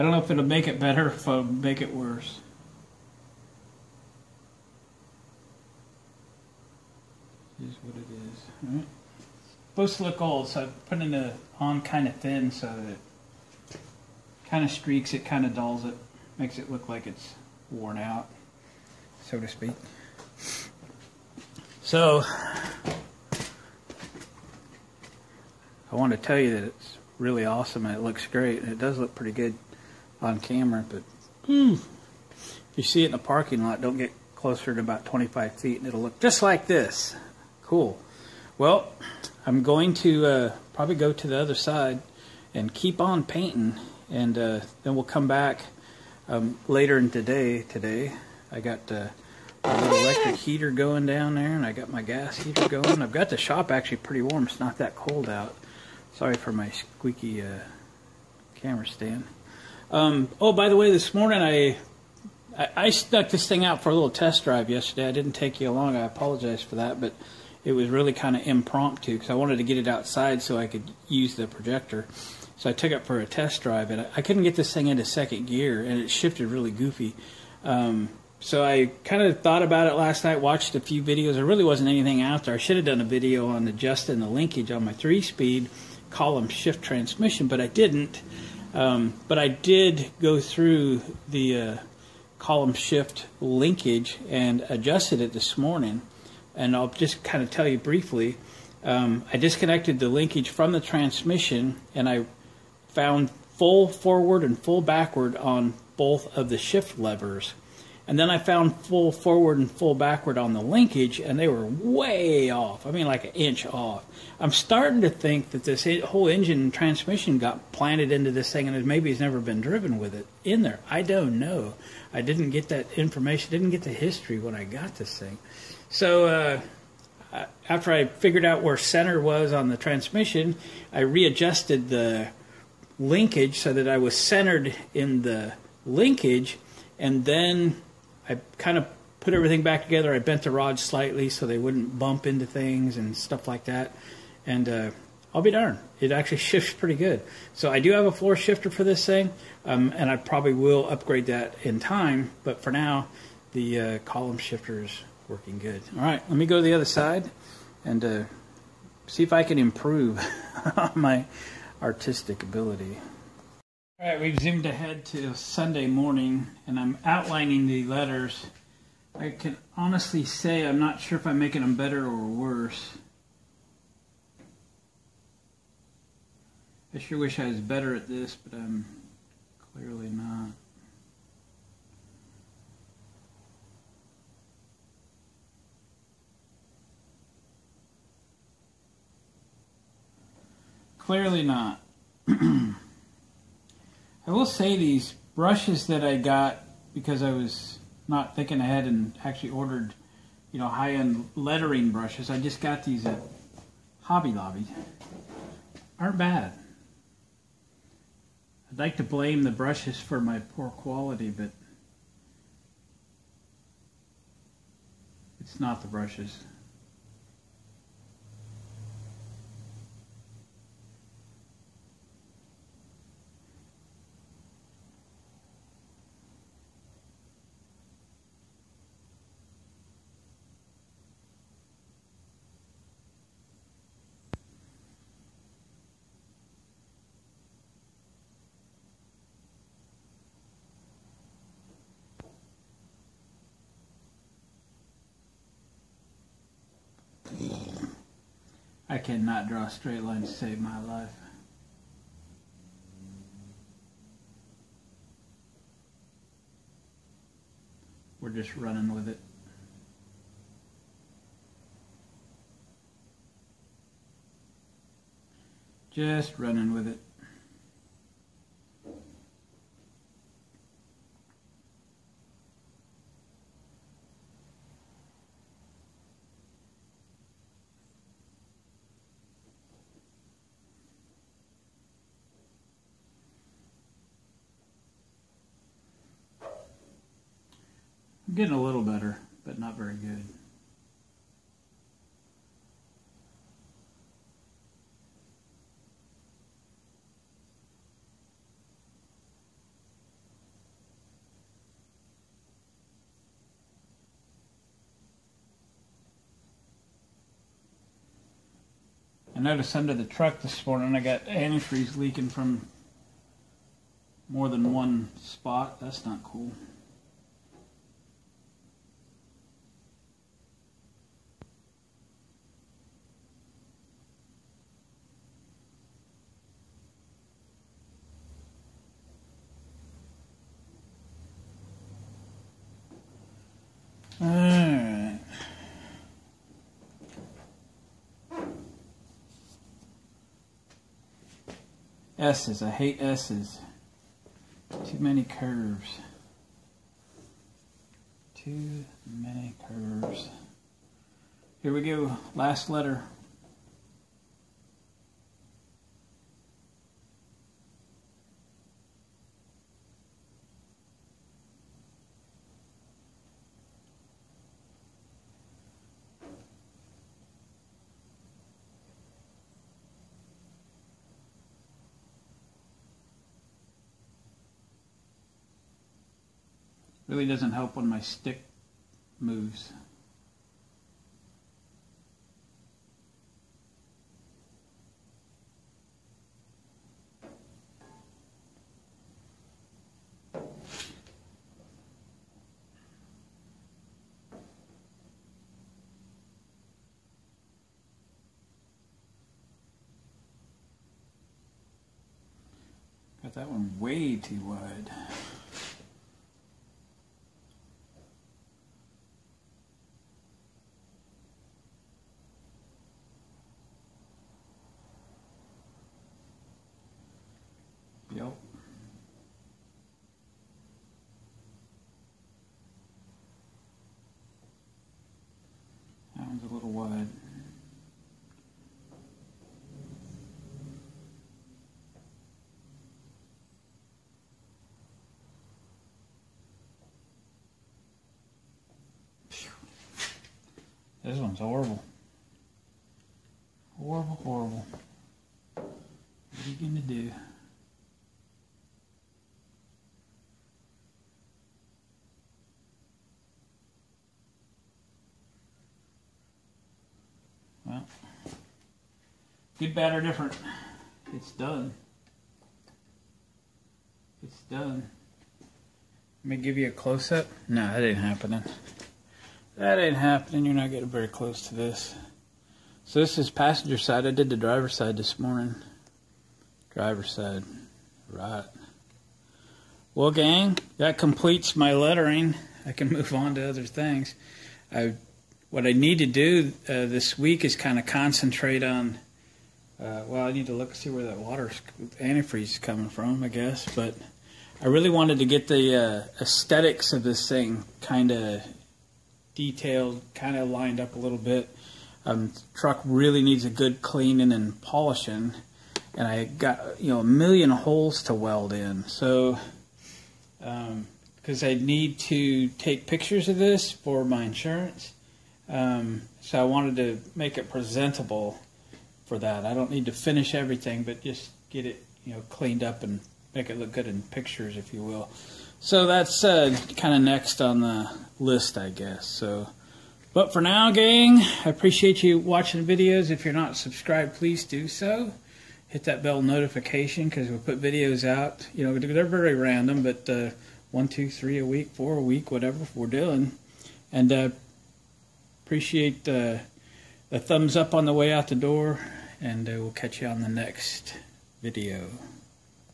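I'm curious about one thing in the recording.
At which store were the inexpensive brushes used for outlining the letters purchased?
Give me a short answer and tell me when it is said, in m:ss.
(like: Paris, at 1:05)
Hobby Lobby, at 3:24.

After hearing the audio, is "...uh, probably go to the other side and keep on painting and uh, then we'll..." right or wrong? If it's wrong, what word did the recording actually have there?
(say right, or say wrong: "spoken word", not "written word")
right.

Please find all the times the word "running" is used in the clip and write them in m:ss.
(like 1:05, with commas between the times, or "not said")
4:18, 4:26.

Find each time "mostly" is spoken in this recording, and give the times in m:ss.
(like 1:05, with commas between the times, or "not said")
not said.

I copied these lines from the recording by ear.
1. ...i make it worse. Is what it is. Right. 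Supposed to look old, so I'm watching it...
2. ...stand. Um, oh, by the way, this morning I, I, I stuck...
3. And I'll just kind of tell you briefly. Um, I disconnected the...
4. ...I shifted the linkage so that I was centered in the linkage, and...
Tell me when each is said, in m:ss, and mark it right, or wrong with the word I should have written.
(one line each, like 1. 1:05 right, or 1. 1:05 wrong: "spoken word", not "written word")
1. 0:01 wrong: "putting", not "watching"
2. 0:58 right
3. 1:36 right
4. 2:10 wrong: "readjusted", not "shifted".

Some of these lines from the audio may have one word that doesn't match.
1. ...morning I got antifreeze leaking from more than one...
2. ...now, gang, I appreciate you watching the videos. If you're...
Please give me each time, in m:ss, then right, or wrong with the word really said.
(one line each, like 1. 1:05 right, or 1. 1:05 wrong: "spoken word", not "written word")
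1. 5:10 right
2. 8:50 right.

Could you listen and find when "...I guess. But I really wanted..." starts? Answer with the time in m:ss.
8:13.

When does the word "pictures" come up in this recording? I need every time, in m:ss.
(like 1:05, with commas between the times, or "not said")
8:32, 8:44.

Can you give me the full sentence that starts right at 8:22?
Um, truck really needs a good cleaning and polishing.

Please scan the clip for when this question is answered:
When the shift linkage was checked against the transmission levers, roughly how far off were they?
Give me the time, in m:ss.
1:53.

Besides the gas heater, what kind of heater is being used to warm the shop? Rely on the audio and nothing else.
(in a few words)
electric heater.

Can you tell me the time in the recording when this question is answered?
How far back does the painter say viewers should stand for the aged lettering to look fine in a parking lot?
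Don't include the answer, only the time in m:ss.
0:35.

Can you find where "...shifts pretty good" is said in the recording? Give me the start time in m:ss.
2:26.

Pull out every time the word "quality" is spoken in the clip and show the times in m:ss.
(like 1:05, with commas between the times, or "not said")
3:30.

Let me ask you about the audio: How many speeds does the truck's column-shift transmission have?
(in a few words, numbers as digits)
3.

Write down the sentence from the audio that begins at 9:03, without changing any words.
And uh, appreciate uh, the thumbs up on the way out the door, and uh, we'll catch you on the next video.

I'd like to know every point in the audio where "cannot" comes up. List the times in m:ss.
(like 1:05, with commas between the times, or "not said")
4:08.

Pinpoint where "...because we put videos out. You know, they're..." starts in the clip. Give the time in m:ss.
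8:57.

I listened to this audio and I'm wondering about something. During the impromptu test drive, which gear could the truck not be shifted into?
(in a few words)
second gear.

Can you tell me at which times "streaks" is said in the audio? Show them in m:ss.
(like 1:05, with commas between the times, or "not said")
0:14.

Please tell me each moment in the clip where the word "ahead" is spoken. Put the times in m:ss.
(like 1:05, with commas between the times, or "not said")
2:44, 3:18.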